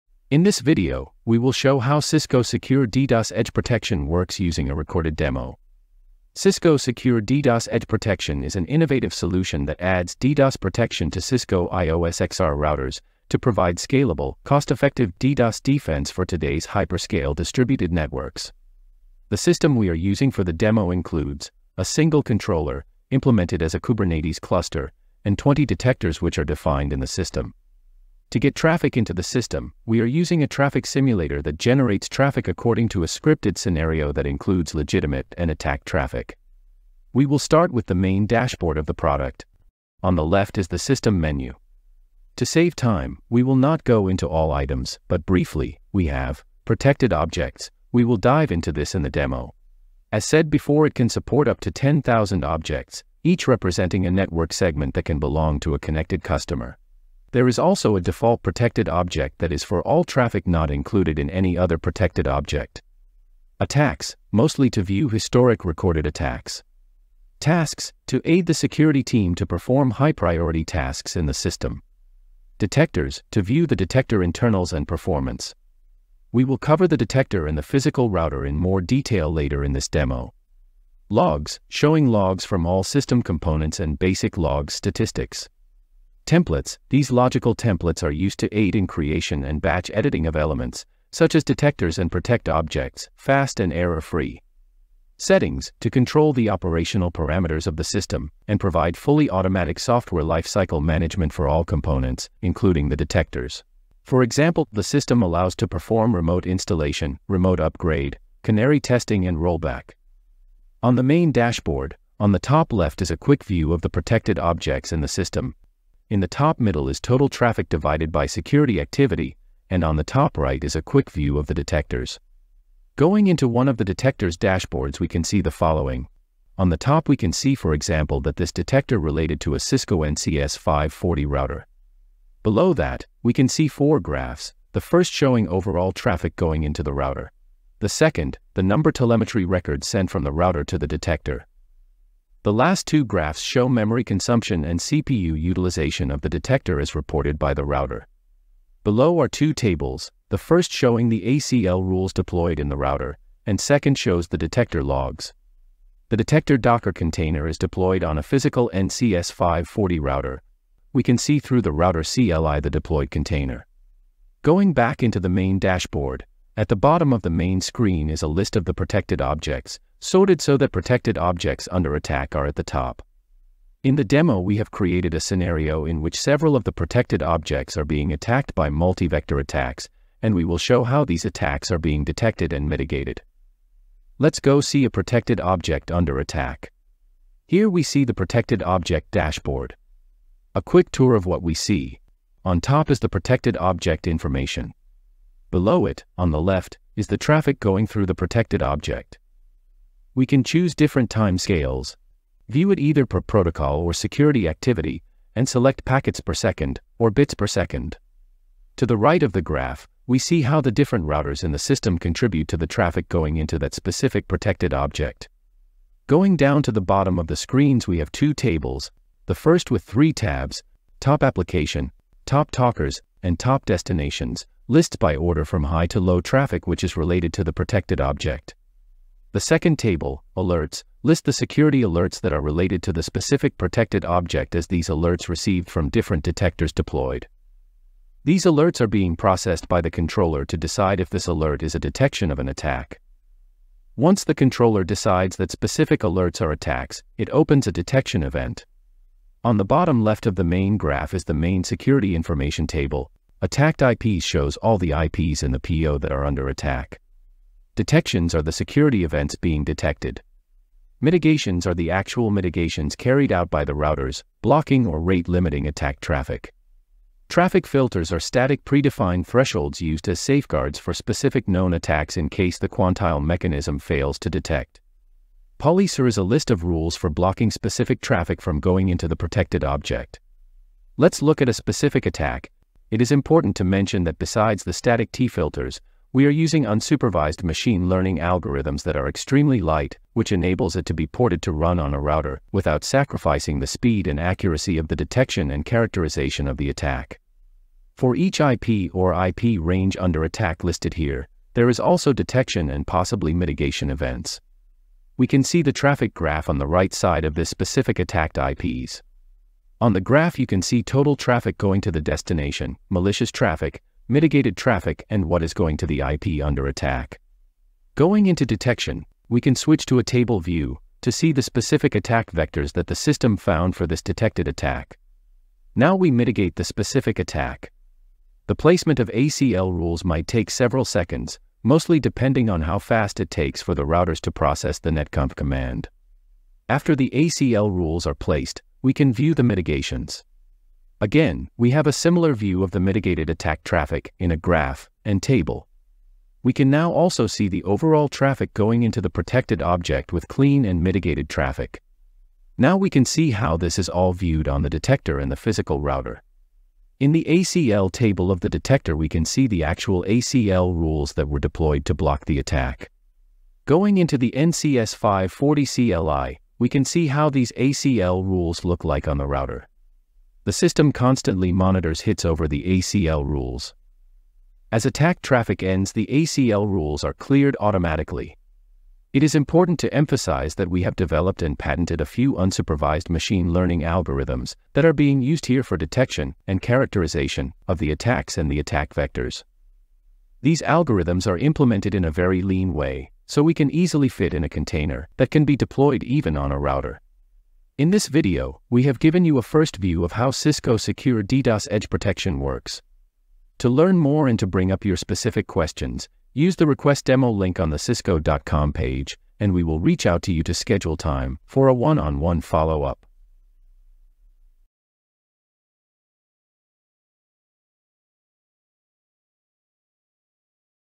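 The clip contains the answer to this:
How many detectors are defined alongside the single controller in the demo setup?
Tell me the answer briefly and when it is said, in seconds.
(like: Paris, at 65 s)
20, at 25 s.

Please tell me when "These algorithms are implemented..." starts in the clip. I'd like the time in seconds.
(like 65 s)
390 s.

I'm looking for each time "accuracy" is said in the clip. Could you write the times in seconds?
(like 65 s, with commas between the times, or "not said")
294 s.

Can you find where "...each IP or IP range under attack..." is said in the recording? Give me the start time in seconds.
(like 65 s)
298 s.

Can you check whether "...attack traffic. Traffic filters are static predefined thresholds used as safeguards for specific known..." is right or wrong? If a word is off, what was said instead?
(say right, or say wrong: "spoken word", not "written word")
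right.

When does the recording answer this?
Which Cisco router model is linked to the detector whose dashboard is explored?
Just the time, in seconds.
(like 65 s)
129 s.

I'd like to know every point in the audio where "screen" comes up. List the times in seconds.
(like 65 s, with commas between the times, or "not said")
167 s, 217 s.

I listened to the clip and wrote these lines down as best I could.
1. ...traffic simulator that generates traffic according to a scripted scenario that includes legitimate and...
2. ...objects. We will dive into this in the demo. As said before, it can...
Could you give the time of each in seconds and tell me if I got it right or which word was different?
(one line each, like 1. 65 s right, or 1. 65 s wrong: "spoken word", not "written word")
1. 30 s right
2. 47 s right.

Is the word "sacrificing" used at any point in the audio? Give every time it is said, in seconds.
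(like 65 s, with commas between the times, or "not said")
292 s.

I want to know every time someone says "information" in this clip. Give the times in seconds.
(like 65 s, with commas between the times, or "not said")
194 s, 252 s.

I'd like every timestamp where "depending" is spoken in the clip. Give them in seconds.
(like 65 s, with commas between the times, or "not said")
332 s.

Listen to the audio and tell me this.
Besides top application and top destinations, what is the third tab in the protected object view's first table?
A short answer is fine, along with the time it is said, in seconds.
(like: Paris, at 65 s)
top talkers, at 222 s.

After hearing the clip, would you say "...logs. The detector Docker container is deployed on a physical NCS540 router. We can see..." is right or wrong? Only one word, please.
right.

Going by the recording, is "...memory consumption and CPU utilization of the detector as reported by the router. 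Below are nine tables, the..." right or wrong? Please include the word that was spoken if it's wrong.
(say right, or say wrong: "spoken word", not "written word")
wrong: "two", not "nine".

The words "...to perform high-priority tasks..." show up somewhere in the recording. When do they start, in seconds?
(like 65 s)
69 s.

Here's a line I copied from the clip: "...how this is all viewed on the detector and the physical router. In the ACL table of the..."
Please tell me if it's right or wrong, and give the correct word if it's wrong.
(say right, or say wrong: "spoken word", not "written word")
right.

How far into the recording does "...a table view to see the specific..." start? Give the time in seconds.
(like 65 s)
319 s.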